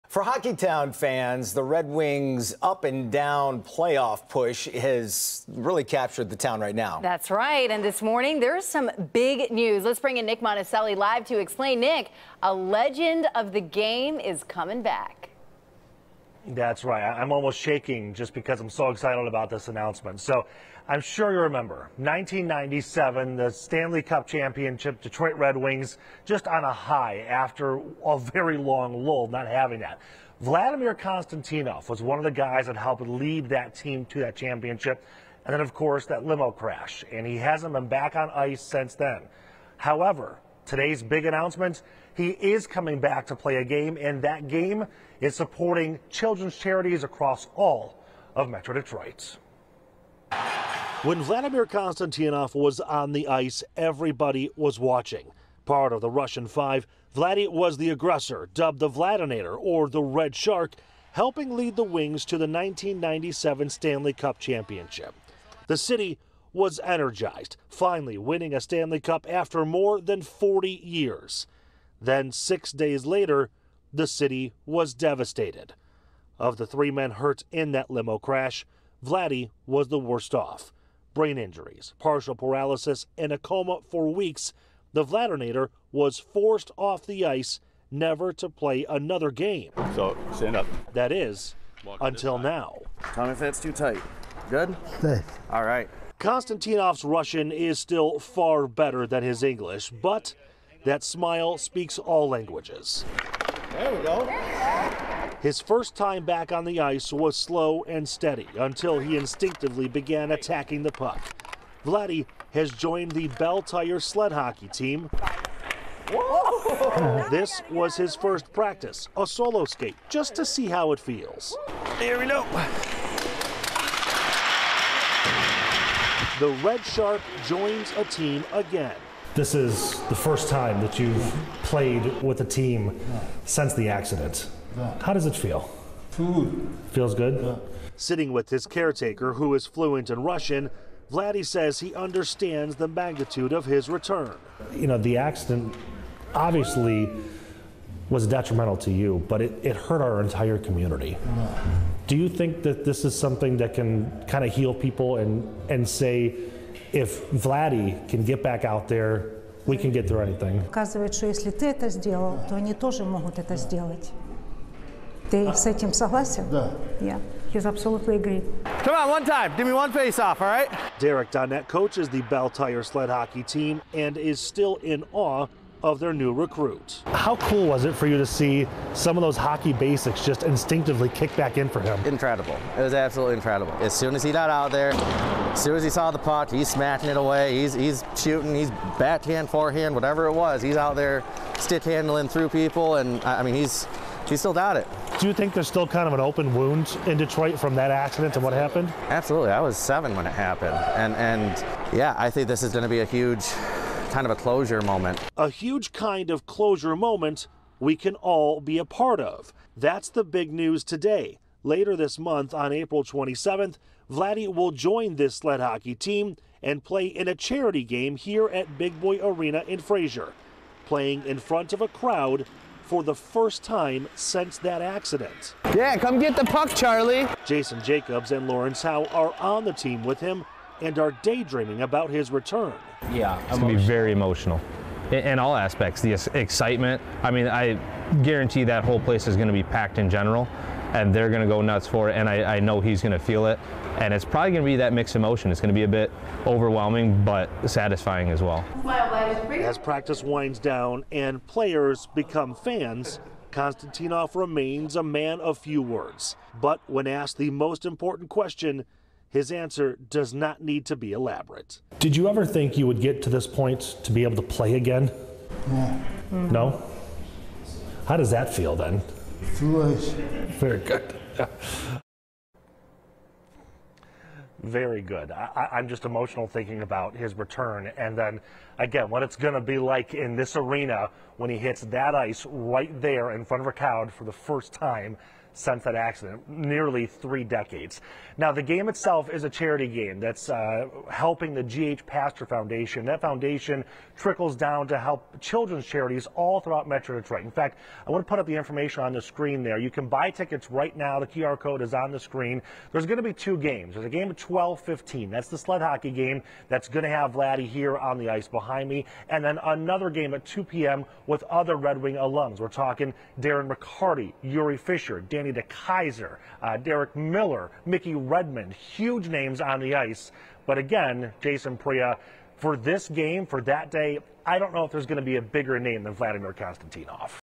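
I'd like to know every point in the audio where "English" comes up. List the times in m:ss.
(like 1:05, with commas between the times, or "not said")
1:39.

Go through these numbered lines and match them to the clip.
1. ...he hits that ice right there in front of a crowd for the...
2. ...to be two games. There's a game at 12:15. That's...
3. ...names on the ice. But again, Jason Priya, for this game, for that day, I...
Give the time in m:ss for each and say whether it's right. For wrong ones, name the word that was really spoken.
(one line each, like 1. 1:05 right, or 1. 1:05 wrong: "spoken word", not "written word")
1. 4:41 right
2. 5:03 right
3. 5:19 right.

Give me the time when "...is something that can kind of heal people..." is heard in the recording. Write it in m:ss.
2:33.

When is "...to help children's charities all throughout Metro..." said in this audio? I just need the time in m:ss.
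4:54.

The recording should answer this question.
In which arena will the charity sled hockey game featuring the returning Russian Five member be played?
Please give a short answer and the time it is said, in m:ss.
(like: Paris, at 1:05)
Big Boy Arena, at 3:38.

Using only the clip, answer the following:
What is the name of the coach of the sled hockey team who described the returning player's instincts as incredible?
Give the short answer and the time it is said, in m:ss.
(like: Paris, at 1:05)
Derek Donnet, at 2:50.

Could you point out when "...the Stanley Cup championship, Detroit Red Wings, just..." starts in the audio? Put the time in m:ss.
0:23.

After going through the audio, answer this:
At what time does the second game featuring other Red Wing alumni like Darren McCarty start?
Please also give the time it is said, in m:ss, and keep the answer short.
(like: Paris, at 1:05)
2 p.m., at 5:10.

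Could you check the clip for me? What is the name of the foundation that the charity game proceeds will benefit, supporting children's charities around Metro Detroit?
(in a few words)
G.H. Pastor Foundation.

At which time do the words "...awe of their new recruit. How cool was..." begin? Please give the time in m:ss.
2:55.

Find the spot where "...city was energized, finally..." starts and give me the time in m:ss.
1:05.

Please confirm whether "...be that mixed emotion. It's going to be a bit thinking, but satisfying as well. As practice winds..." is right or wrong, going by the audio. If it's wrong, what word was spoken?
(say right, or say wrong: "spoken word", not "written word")
wrong: "overwhelming", not "thinking".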